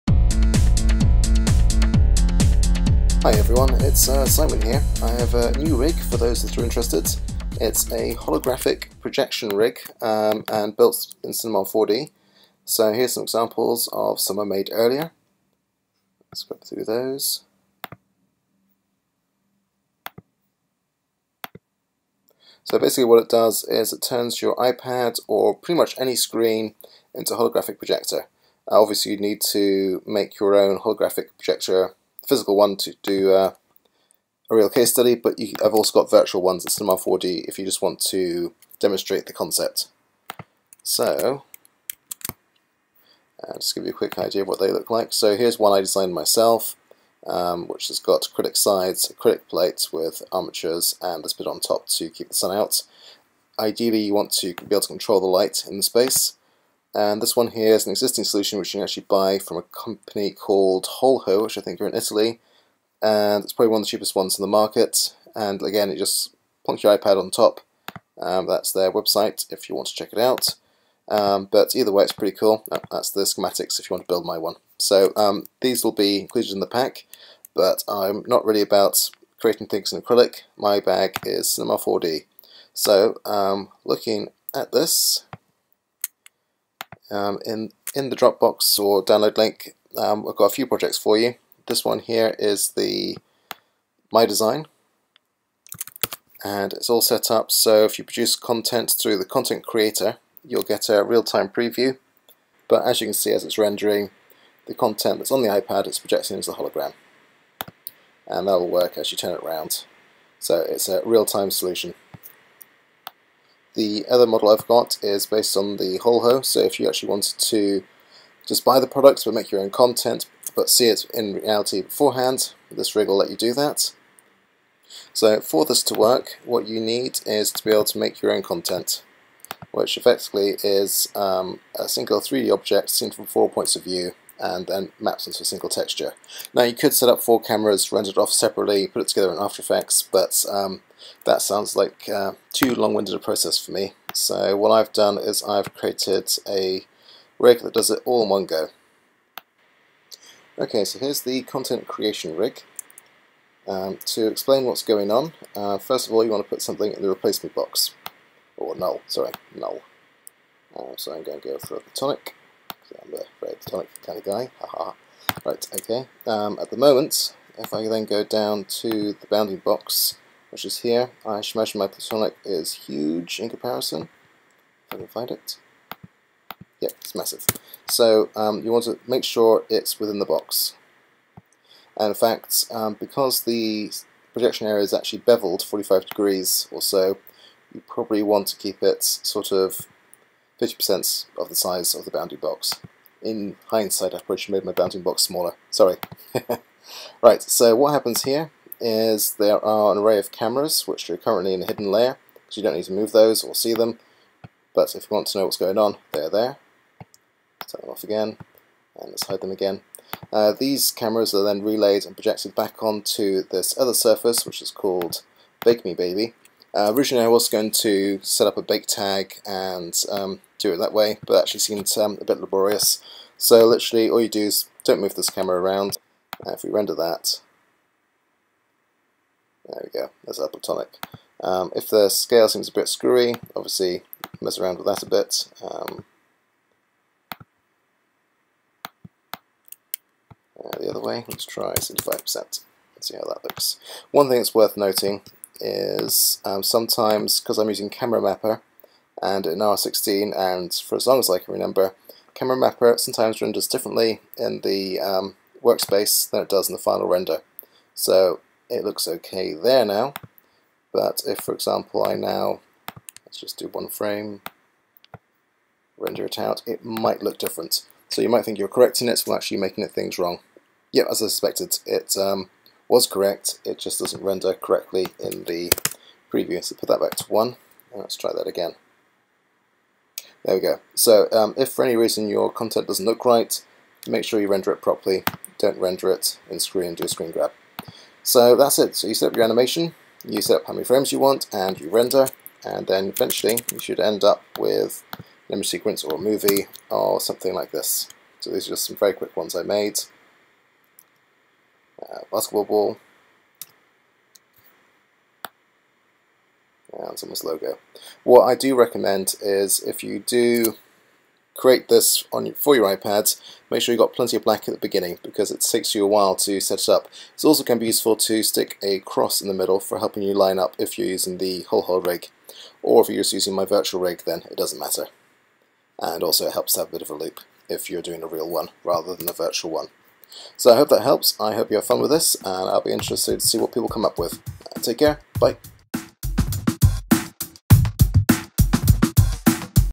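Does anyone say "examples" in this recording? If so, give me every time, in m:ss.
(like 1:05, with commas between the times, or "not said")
0:13, 4:21.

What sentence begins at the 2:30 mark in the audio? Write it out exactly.
Okay, so here's the content creation rig.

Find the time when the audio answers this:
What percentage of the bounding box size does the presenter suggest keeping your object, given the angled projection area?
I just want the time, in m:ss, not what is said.
3:10.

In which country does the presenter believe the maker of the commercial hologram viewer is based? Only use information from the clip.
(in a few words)
Italy.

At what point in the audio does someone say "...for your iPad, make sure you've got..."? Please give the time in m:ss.
5:12.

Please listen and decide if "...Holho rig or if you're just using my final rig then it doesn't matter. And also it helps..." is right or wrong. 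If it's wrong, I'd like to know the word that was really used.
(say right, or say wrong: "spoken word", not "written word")
wrong: "virtual", not "final".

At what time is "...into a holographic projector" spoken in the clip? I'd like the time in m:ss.
0:27.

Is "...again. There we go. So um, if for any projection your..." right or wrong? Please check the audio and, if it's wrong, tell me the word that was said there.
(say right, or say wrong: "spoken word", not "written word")
wrong: "reason", not "projection".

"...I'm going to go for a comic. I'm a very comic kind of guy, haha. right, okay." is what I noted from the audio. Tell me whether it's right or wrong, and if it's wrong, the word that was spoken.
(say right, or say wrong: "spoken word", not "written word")
wrong: "tonic", not "comic".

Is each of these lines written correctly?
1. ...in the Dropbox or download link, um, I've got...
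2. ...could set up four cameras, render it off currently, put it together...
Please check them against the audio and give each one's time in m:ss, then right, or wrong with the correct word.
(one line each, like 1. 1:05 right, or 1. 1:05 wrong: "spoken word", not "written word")
1. 1:27 right
2. 2:16 wrong: "separately", not "currently".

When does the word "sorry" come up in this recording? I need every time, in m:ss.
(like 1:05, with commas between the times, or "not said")
2:39, 3:15.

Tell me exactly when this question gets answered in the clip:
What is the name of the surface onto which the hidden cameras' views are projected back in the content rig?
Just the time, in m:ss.
3:35.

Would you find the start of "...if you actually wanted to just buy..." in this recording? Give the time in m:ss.
1:56.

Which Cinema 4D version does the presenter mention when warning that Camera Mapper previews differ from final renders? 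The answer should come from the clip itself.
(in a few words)
R16.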